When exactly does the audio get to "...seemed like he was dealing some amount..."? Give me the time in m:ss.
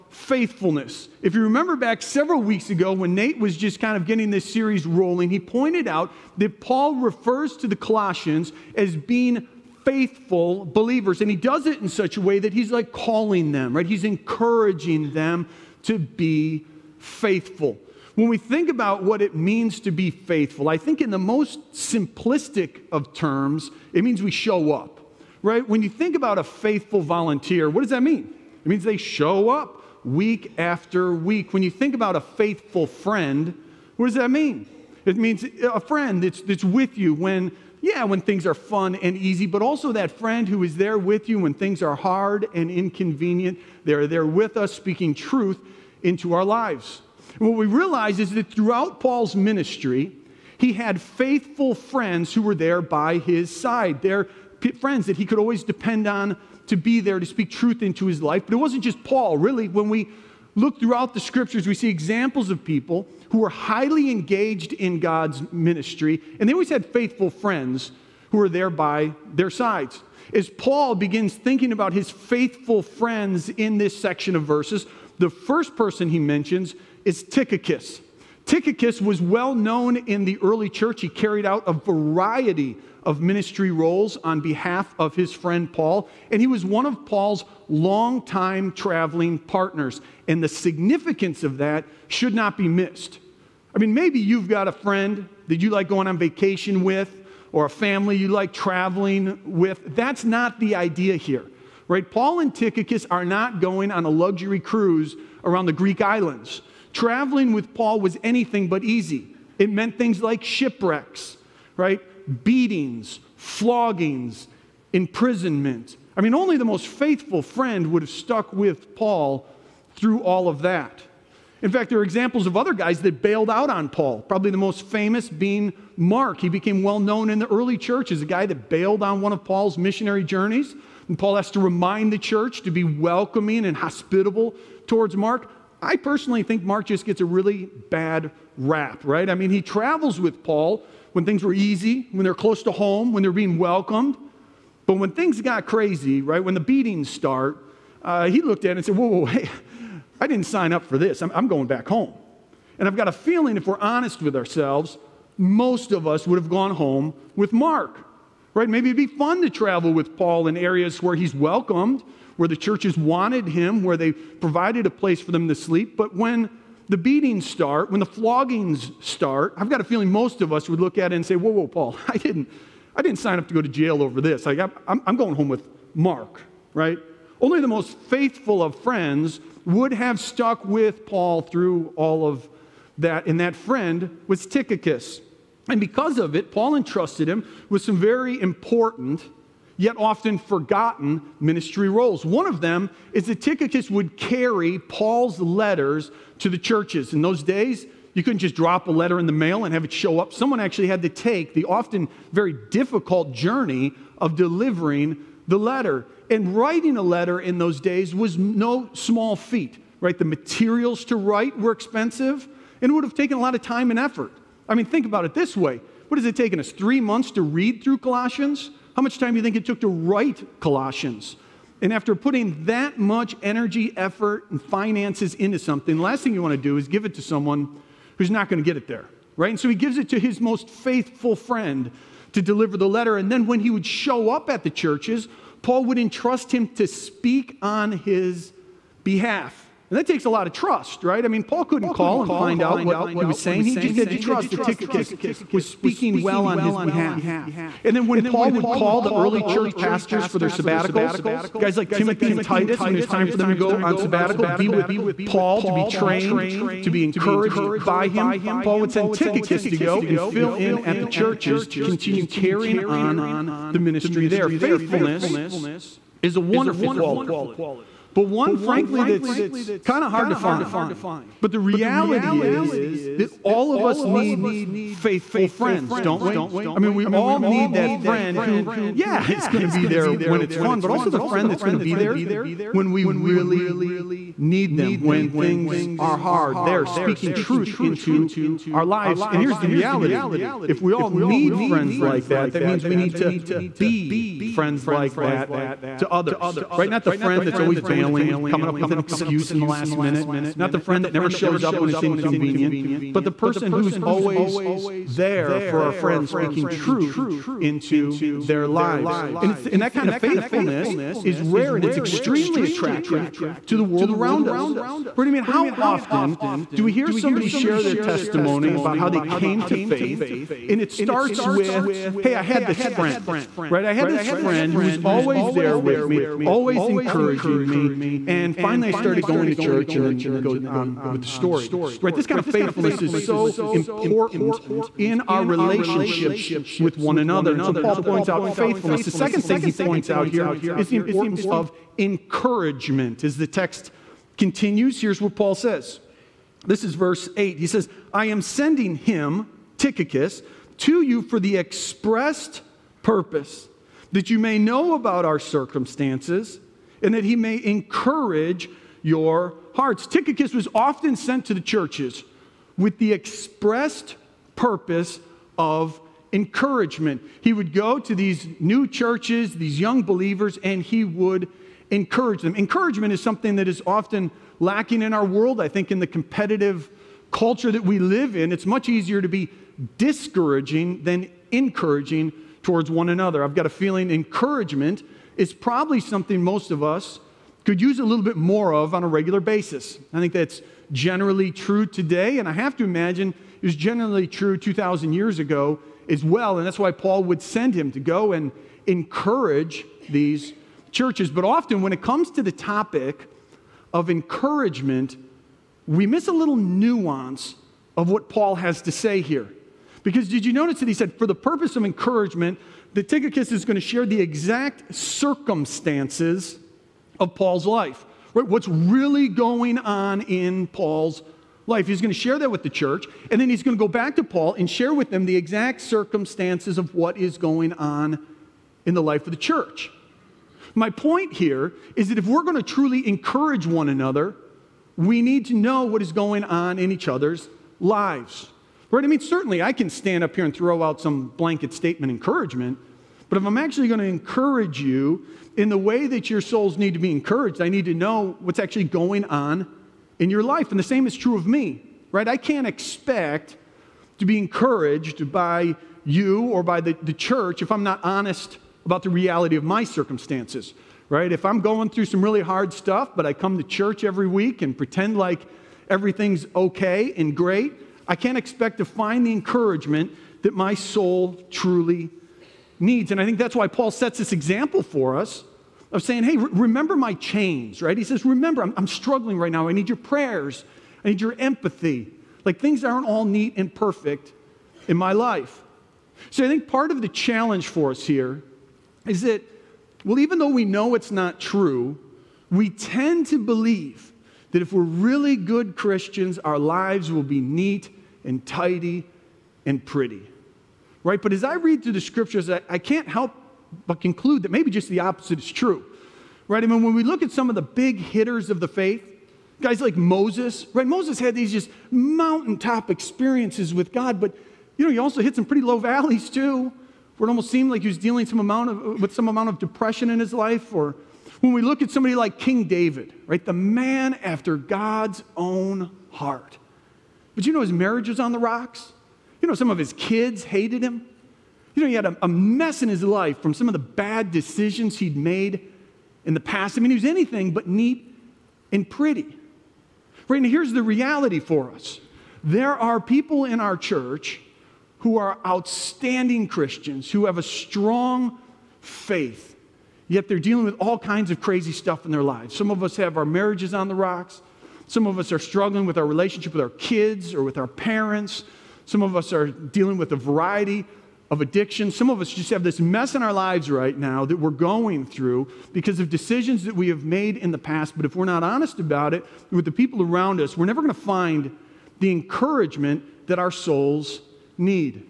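8:37.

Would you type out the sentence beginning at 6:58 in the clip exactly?
What's really going on in Paul's life.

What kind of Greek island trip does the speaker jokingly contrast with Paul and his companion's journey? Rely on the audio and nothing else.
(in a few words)
A luxury cruise.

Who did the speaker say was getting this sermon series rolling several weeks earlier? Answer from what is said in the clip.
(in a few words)
Nate.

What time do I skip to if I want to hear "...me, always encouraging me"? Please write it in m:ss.
5:26.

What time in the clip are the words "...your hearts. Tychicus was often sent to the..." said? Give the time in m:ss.
5:59.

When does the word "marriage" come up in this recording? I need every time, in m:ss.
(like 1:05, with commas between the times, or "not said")
8:47, 9:13.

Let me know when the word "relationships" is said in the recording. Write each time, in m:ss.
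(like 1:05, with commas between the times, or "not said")
5:35, 9:16.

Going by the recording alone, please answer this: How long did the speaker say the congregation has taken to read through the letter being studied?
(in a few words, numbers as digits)
3 months.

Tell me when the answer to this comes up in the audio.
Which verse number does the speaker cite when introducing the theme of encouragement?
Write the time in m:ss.
5:46.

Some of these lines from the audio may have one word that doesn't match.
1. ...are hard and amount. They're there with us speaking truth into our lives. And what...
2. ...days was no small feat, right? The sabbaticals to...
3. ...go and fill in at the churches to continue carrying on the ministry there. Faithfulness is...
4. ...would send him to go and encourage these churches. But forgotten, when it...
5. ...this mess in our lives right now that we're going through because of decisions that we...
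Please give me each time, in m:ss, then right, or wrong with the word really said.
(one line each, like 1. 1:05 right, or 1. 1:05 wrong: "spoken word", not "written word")
1. 0:41 wrong: "inconvenient", not "amount"
2. 3:27 wrong: "materials", not "sabbaticals"
3. 4:19 right
4. 6:37 wrong: "often", not "forgotten"
5. 9:22 right.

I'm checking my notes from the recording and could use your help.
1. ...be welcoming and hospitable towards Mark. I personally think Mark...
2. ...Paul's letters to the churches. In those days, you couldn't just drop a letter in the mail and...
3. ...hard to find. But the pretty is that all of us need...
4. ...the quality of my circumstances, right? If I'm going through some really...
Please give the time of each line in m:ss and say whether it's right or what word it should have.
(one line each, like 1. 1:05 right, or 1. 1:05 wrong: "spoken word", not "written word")
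1. 2:12 right
2. 3:14 right
3. 4:30 wrong: "reality", not "pretty"
4. 7:39 wrong: "reality", not "quality".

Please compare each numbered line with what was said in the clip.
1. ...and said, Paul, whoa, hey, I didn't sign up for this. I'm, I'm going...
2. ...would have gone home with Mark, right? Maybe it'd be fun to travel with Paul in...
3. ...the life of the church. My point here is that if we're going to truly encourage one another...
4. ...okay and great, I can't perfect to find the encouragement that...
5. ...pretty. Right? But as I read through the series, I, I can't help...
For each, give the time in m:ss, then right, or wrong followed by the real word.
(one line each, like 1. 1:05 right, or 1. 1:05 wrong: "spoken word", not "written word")
1. 2:28 wrong: "Whoa", not "Paul"
2. 2:36 right
3. 7:08 right
4. 7:46 wrong: "expect", not "perfect"
5. 8:19 wrong: "scriptures", not "series".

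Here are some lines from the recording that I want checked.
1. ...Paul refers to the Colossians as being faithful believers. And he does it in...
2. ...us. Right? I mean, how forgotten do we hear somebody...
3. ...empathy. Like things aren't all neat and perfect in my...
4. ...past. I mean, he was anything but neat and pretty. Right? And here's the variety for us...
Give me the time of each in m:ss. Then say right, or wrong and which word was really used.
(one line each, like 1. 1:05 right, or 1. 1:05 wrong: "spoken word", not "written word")
1. 0:06 right
2. 5:14 wrong: "often", not "forgotten"
3. 8:01 right
4. 8:56 wrong: "reality", not "variety".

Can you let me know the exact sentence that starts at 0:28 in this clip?
It means they show up week after week.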